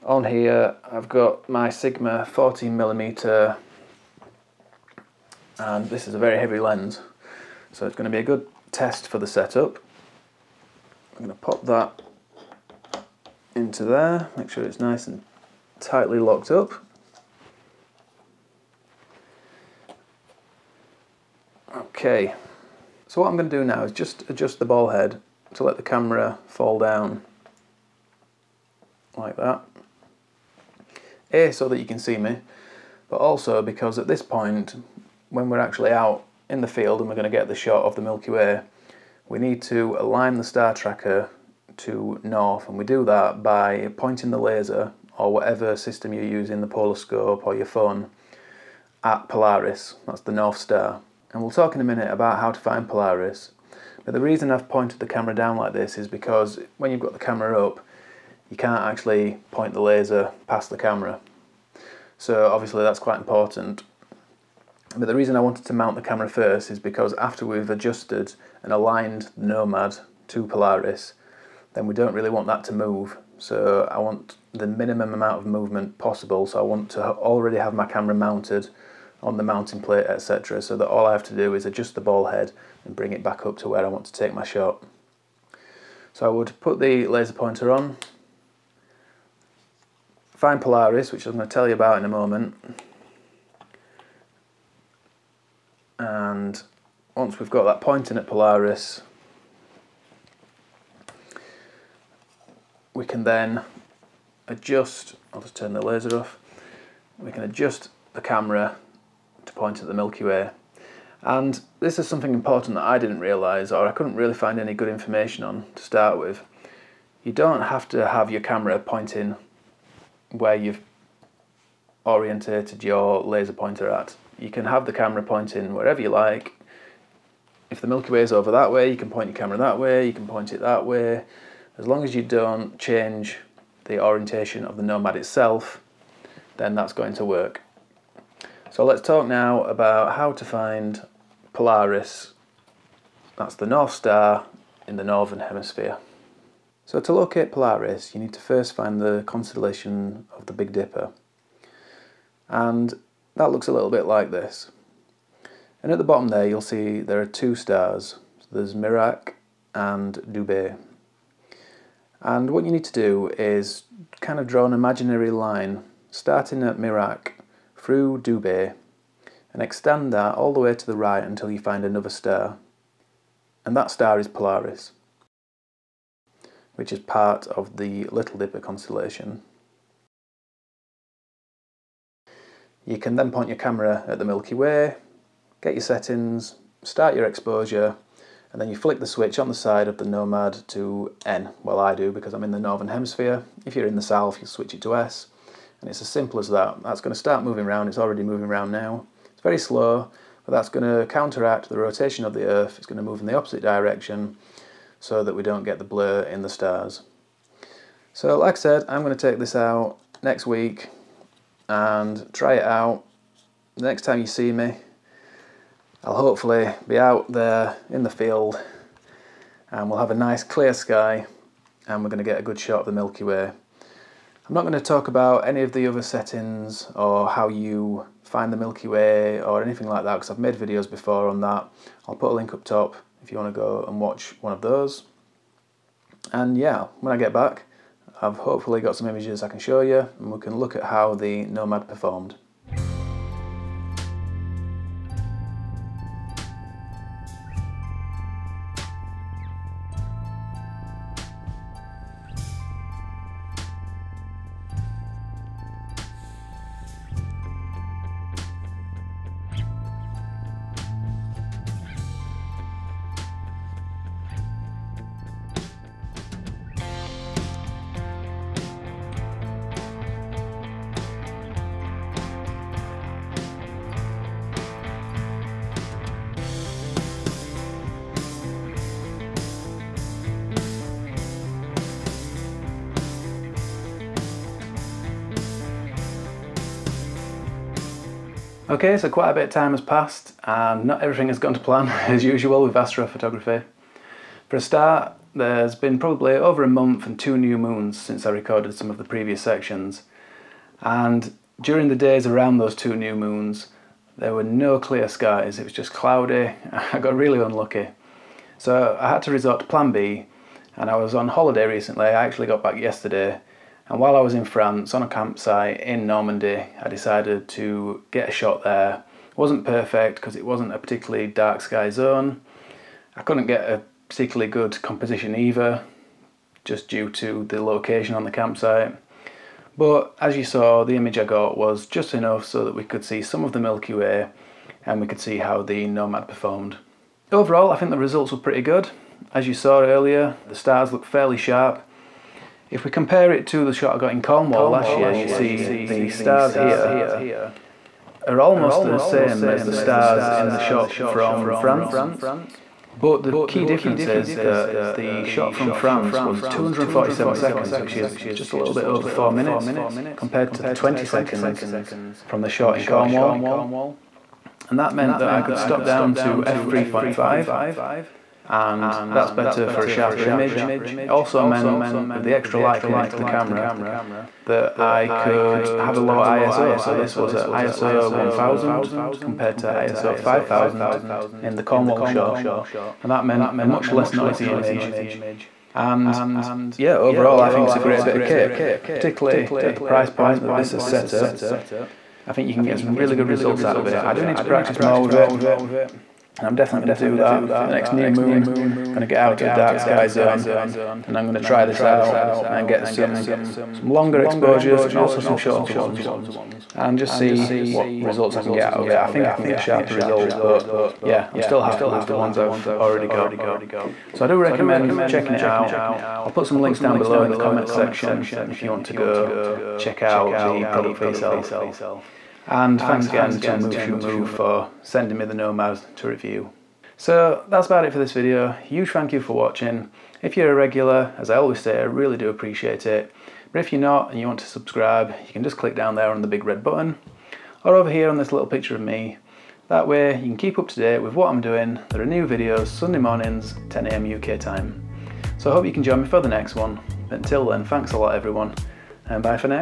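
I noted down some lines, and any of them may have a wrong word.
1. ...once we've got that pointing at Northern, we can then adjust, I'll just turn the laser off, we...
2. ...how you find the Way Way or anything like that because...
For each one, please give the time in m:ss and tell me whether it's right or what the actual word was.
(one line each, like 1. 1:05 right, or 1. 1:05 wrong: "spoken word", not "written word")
1. 1:37 wrong: "Polaris", not "Northern"
2. 3:47 wrong: "Milky", not "Way".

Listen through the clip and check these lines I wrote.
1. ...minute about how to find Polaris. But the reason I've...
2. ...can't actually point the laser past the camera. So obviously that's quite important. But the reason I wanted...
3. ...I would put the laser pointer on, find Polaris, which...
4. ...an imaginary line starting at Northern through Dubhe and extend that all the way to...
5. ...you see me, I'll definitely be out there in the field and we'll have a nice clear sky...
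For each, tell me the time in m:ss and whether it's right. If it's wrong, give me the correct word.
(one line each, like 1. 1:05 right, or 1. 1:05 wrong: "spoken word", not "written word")
1. 0:51 right
2. 0:58 right
3. 1:26 right
4. 2:44 wrong: "Merak", not "Northern"
5. 3:34 wrong: "hopefully", not "definitely".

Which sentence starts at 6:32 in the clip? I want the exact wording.
I think you can get some really good results out of it.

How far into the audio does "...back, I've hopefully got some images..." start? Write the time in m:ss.
3:57.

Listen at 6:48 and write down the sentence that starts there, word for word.
I think I can get sharper results but yeah I'm still happy with the ones I've already got.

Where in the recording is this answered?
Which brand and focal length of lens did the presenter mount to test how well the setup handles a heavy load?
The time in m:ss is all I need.
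0:01.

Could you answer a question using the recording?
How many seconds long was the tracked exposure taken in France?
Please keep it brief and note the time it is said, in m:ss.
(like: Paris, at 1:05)
247, at 5:56.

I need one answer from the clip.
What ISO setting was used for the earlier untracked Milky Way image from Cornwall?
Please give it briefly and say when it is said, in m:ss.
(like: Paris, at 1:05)
ISO 5000, at 6:19.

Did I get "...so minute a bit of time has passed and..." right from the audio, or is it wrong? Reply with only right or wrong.
wrong.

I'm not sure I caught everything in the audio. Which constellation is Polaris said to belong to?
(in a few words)
Little Dipper.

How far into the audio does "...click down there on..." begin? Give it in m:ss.
7:15.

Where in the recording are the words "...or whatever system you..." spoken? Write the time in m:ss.
0:45.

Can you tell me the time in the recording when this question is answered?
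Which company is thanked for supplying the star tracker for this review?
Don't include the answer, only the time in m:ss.
7:03.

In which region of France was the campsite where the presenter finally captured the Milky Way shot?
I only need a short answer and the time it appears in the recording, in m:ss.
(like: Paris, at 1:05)
Normandy, at 5:16.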